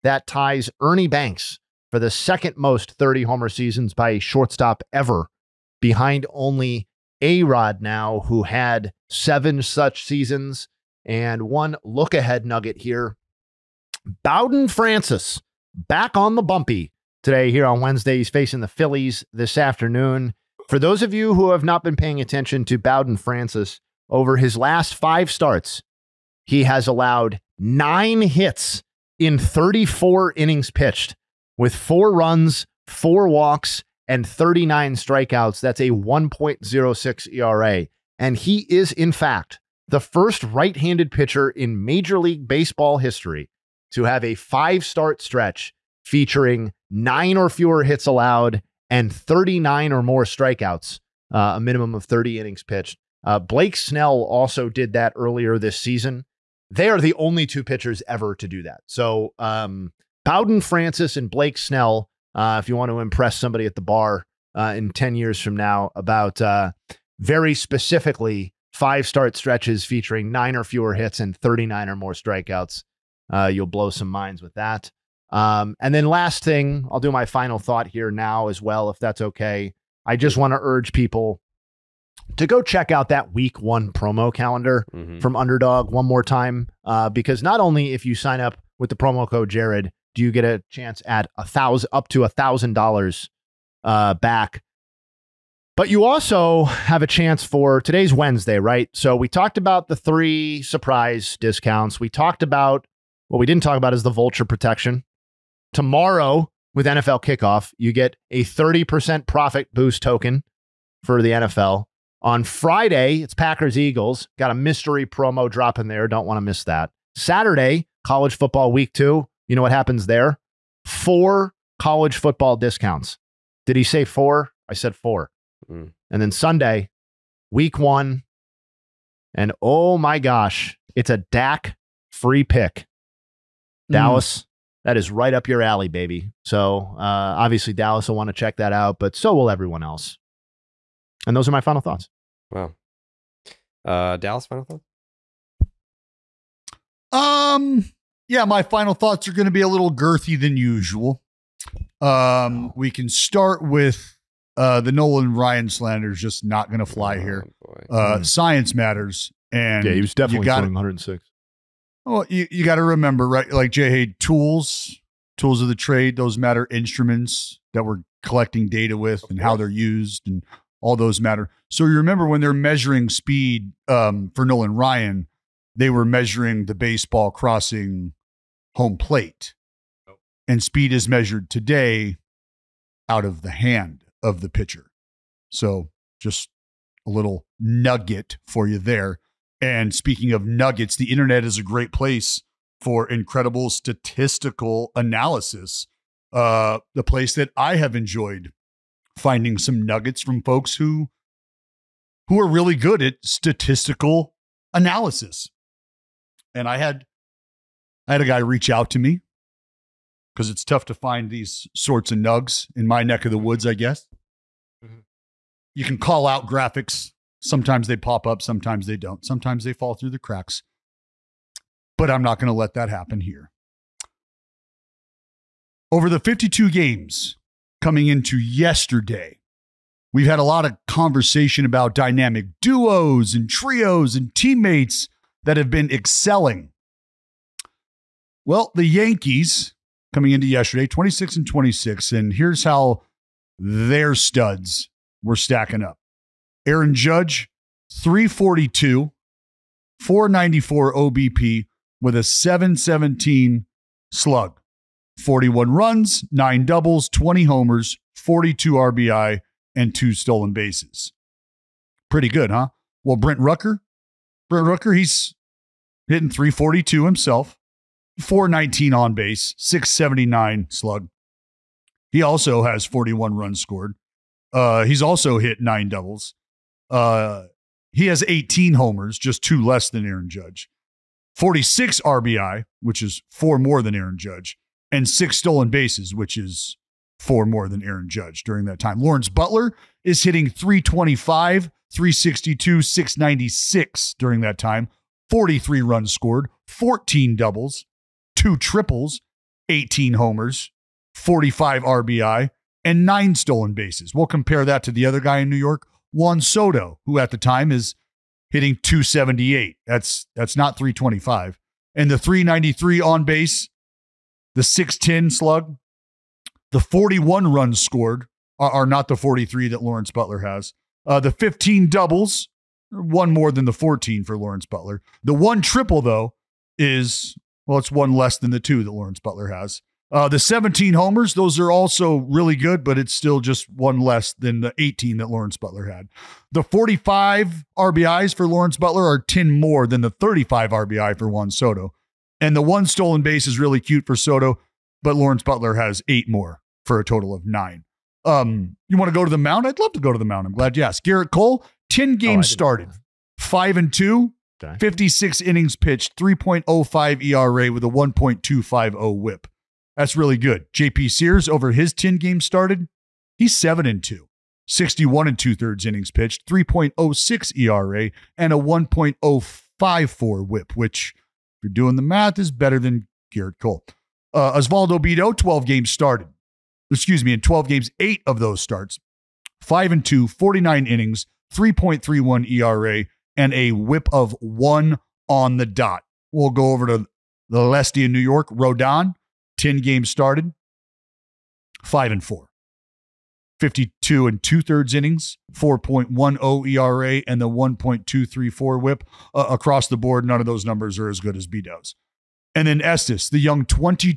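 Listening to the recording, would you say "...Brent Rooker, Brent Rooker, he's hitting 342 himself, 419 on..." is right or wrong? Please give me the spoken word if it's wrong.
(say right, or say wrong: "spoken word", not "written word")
right.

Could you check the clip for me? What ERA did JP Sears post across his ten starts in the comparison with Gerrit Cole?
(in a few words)
3.06.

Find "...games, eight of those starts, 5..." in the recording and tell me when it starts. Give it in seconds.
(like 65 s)
377 s.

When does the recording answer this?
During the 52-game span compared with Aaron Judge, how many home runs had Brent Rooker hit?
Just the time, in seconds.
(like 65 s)
277 s.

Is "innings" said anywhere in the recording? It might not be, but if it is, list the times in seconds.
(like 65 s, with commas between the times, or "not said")
30 s, 52 s, 355 s, 365 s, 380 s, 394 s.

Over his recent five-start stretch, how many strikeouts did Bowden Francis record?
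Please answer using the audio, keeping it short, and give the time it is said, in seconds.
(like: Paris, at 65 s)
39, at 34 s.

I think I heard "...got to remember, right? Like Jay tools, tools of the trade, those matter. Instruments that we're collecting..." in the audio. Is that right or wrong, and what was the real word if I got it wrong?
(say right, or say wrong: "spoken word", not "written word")
right.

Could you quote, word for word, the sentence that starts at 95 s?
But you also have a chance for today's Wednesday, right?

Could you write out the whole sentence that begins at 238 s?
Well, the Yankees coming into yesterday, 26 and 26, and here's how their studs were stacking up.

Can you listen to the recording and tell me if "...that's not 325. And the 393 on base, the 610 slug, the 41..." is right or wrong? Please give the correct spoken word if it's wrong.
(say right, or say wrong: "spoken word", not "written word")
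right.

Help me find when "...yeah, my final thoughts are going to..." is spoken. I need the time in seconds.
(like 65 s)
148 s.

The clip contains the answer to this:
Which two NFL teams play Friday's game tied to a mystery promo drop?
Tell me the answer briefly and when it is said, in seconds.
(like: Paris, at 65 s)
Packers Eagles, at 113 s.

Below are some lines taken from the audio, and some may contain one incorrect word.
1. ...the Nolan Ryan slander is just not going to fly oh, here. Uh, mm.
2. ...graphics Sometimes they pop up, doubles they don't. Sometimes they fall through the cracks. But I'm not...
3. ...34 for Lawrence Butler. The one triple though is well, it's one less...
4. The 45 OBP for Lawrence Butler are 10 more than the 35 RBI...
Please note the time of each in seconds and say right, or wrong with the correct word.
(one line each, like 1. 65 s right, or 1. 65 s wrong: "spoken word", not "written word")
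1. 154 s right
2. 216 s wrong: "sometimes", not "doubles"
3. 323 s wrong: "14", not "34"
4. 336 s wrong: "RBIs", not "OBP".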